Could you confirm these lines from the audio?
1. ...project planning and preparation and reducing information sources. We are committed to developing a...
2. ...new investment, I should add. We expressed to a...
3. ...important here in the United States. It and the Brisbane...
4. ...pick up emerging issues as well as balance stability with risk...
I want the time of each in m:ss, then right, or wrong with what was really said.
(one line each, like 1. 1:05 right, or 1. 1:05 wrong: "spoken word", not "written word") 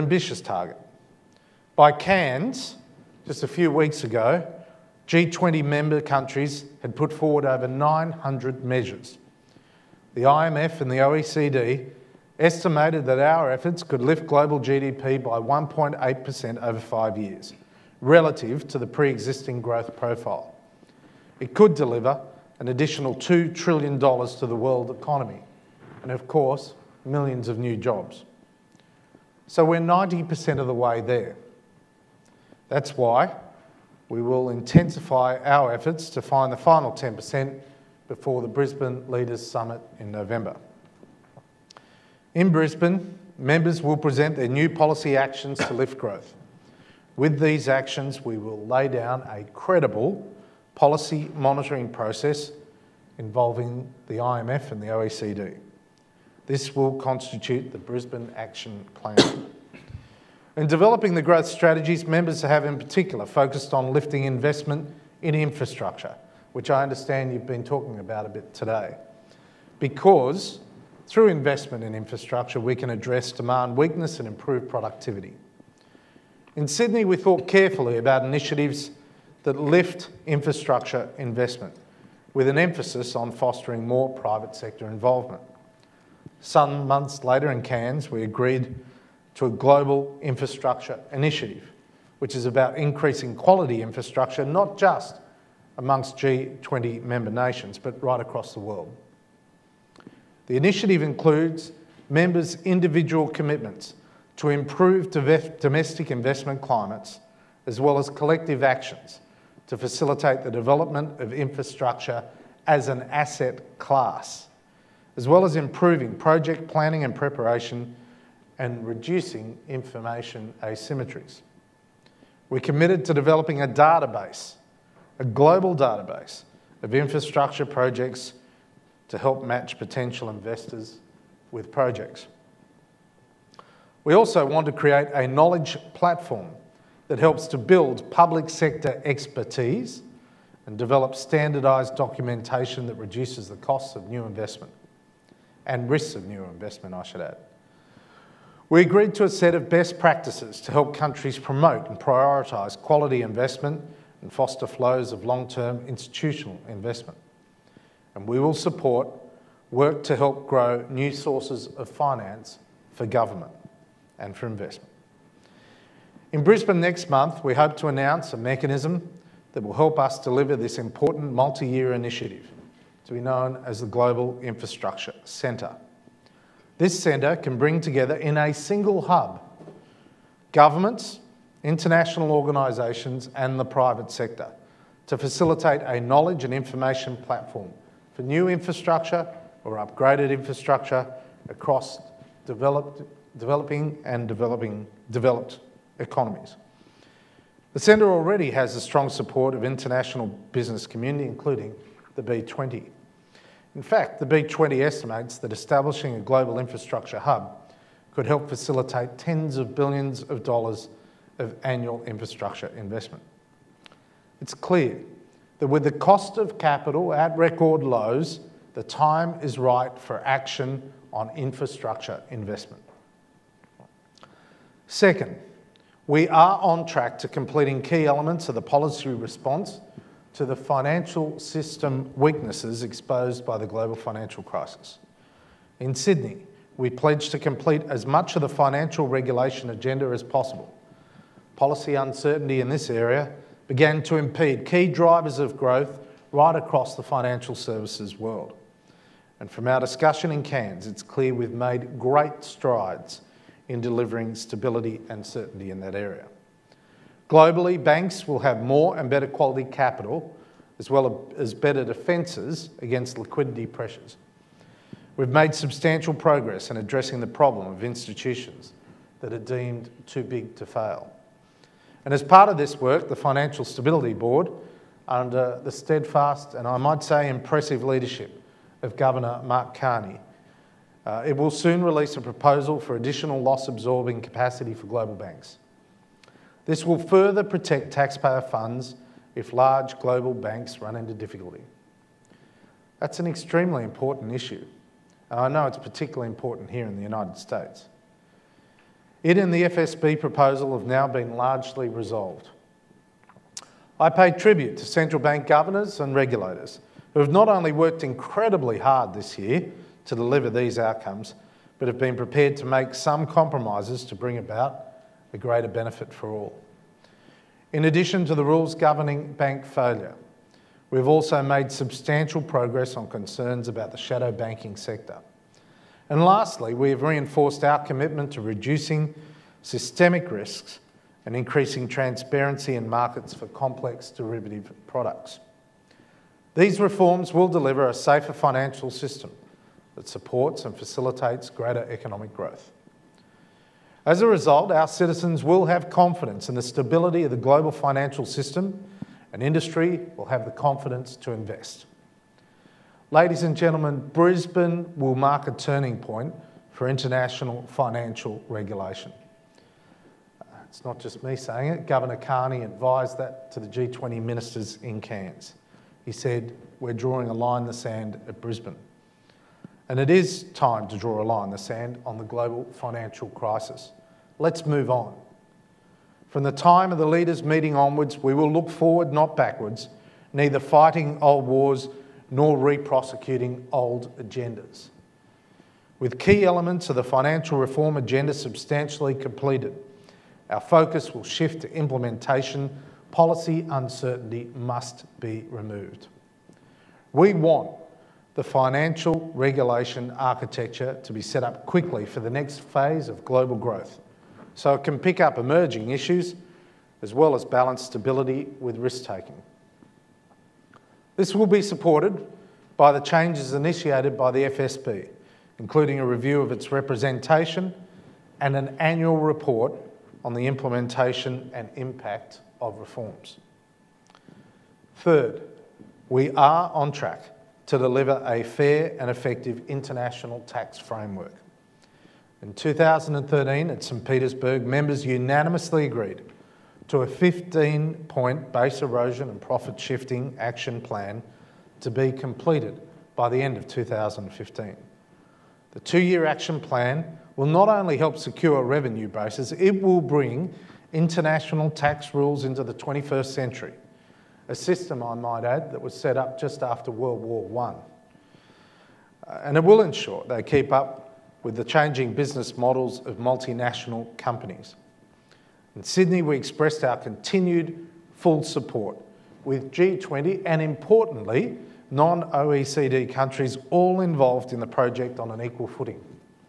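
1. 1:56 wrong: "asymmetries", not "sources"
2. 2:26 wrong: "agreed", not "expressed"
3. 4:56 wrong: "FSB", not "Brisbane"
4. 6:44 right.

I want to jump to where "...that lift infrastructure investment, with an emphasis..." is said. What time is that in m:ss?
1:19.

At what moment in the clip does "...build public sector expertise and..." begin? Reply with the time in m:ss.
2:17.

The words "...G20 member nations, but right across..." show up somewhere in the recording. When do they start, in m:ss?
1:36.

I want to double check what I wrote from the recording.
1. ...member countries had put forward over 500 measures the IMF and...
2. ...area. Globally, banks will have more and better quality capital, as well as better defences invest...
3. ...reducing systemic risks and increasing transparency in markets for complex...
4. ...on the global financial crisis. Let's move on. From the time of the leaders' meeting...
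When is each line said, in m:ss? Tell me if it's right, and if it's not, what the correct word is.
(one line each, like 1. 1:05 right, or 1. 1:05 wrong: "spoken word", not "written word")
1. 0:05 wrong: "900", not "500"
2. 4:15 wrong: "against", not "invest"
3. 5:28 right
4. 6:12 right.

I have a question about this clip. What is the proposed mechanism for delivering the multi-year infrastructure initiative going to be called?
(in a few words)
Global Infrastructure Centre.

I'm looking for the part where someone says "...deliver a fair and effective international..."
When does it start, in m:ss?
7:07.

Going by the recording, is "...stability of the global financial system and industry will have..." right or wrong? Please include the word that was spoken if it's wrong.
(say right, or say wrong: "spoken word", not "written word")
right.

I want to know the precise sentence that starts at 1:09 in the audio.
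Because through investment in infrastructure, we can address demand weakness and improve productivity.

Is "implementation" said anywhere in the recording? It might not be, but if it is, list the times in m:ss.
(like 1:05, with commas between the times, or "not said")
6:31, 7:00.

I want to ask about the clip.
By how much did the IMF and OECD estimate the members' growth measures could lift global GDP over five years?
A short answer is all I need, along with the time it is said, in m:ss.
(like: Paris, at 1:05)
1.8%, at 0:15.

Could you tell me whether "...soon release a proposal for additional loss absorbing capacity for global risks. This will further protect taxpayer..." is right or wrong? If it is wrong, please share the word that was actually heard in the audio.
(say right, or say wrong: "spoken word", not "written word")
wrong: "banks", not "risks".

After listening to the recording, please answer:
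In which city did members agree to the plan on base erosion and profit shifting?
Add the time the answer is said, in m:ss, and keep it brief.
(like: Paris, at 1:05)
St Petersburg, at 7:13.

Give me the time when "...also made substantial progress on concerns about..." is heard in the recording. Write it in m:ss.
5:21.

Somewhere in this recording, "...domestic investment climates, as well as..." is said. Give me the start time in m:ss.
1:45.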